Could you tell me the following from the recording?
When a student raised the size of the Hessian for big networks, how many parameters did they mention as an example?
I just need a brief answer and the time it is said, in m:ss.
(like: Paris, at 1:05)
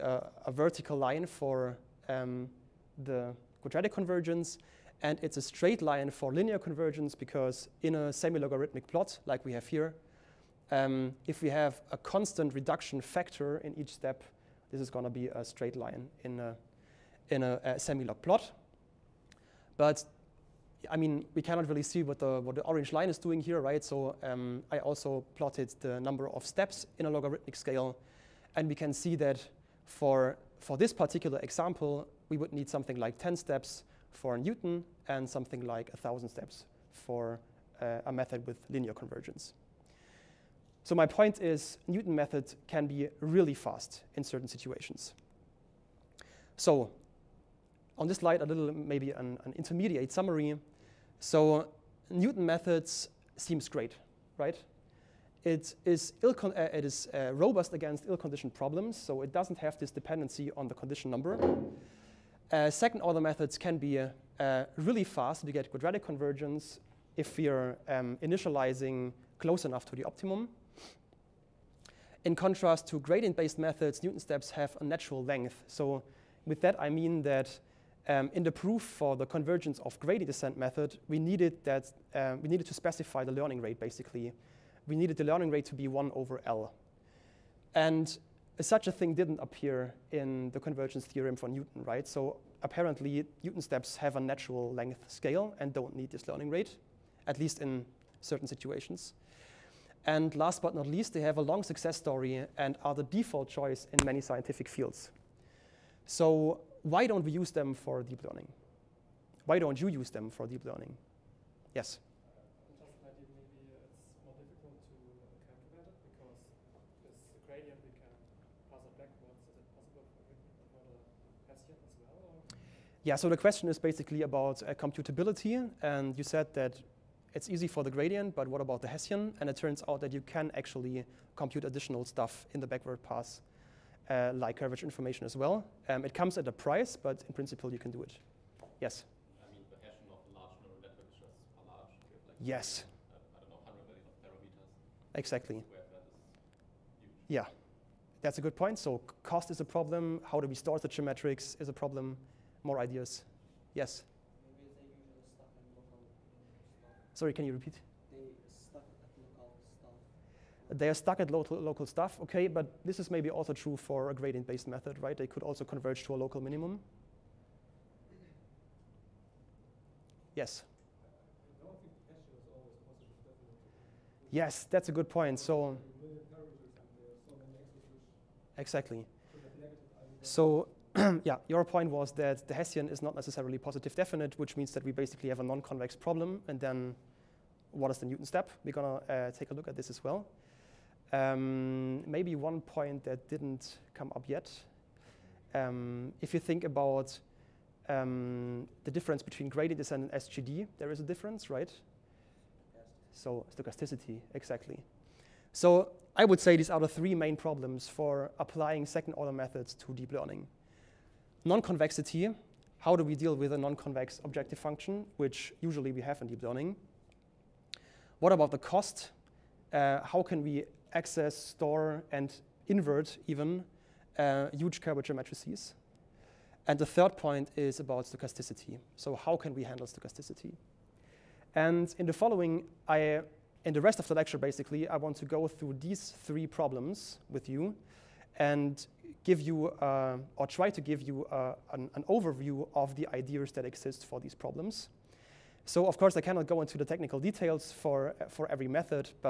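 100 million, at 2:23.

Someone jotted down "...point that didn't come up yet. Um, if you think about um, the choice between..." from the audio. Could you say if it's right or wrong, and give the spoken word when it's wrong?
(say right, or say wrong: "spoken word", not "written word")
wrong: "difference", not "choice".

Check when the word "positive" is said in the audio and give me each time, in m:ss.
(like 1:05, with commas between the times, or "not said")
3:03.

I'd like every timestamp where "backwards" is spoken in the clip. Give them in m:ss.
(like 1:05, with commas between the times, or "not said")
1:58, 2:12.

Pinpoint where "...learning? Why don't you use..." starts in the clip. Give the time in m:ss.
1:48.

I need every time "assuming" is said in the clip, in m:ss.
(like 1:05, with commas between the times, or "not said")
not said.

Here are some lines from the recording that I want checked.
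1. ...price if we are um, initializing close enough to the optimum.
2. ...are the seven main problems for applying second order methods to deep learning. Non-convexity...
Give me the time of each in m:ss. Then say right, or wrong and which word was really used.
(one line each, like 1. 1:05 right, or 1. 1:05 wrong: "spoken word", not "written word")
1. 1:06 wrong: "convergence", not "price"
2. 3:26 wrong: "three", not "seven".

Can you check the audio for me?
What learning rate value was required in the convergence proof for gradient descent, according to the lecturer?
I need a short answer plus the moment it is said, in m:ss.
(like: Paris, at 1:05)
1 over L, at 1:25.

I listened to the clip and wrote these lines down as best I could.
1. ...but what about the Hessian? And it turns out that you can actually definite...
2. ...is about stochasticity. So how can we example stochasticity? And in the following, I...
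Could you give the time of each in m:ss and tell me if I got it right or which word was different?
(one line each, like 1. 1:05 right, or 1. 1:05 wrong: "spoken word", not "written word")
1. 2:08 wrong: "compute", not "definite"
2. 3:47 wrong: "handle", not "example".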